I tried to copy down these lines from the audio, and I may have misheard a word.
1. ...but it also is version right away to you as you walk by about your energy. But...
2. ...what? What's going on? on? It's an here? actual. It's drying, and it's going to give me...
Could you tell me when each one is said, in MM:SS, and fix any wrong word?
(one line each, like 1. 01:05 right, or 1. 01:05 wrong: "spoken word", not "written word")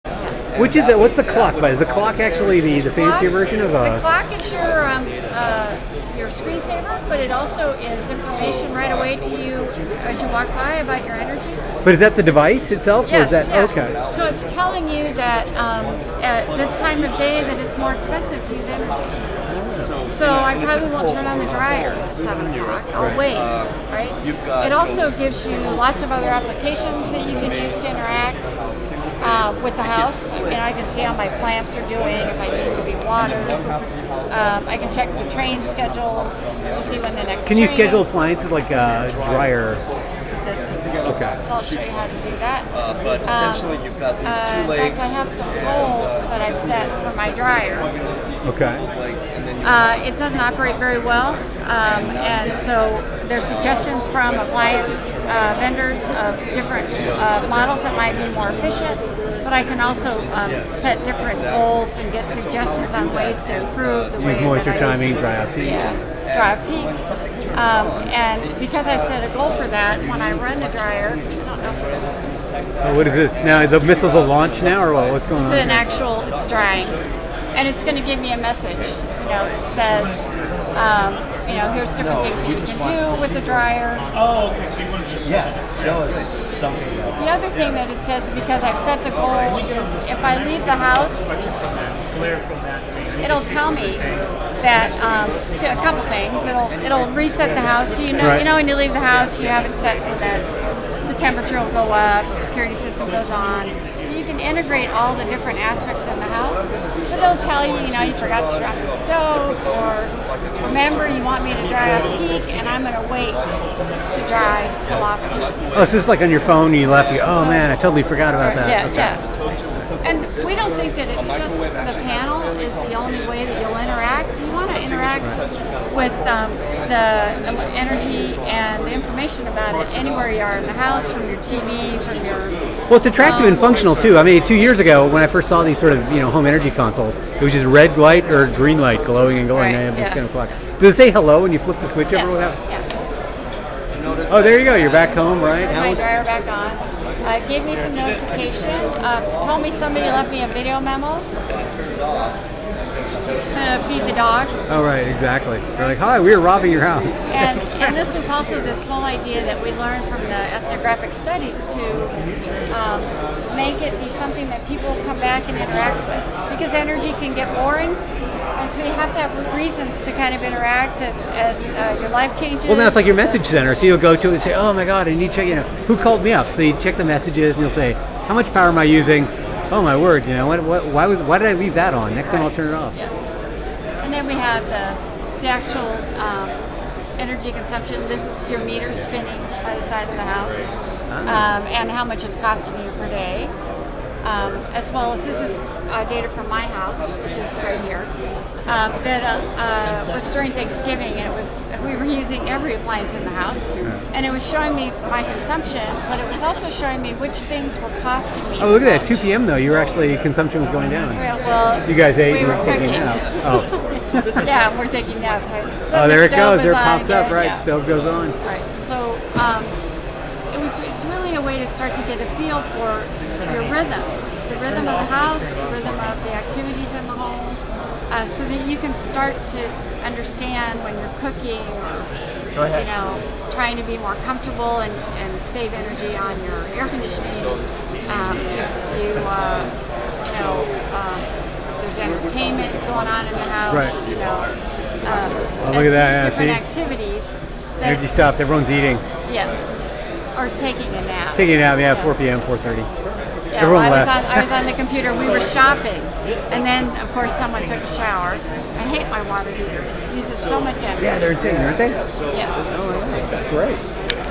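1. 00:07 wrong: "information", not "version"
2. 01:14 right.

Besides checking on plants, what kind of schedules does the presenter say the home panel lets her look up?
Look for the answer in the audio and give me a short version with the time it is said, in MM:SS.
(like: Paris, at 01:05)
train schedules, at 00:35.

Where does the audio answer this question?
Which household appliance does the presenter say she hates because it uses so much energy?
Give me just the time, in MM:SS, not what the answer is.
04:19.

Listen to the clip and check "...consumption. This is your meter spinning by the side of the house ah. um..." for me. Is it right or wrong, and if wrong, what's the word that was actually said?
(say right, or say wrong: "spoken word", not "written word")
right.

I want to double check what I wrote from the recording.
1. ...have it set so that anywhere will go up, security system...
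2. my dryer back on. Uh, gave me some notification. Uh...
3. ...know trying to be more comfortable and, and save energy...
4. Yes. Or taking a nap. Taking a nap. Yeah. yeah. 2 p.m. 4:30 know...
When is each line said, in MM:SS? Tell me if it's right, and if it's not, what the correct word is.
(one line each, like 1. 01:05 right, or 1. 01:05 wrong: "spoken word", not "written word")
1. 01:39 wrong: "temperature", not "anywhere"
2. 02:25 right
3. 03:52 right
4. 04:09 wrong: "4", not "2".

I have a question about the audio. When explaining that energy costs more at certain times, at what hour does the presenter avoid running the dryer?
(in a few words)
7 o'clock.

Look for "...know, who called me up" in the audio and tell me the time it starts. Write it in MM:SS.
02:55.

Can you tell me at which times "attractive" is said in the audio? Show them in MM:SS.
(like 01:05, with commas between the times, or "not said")
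02:13.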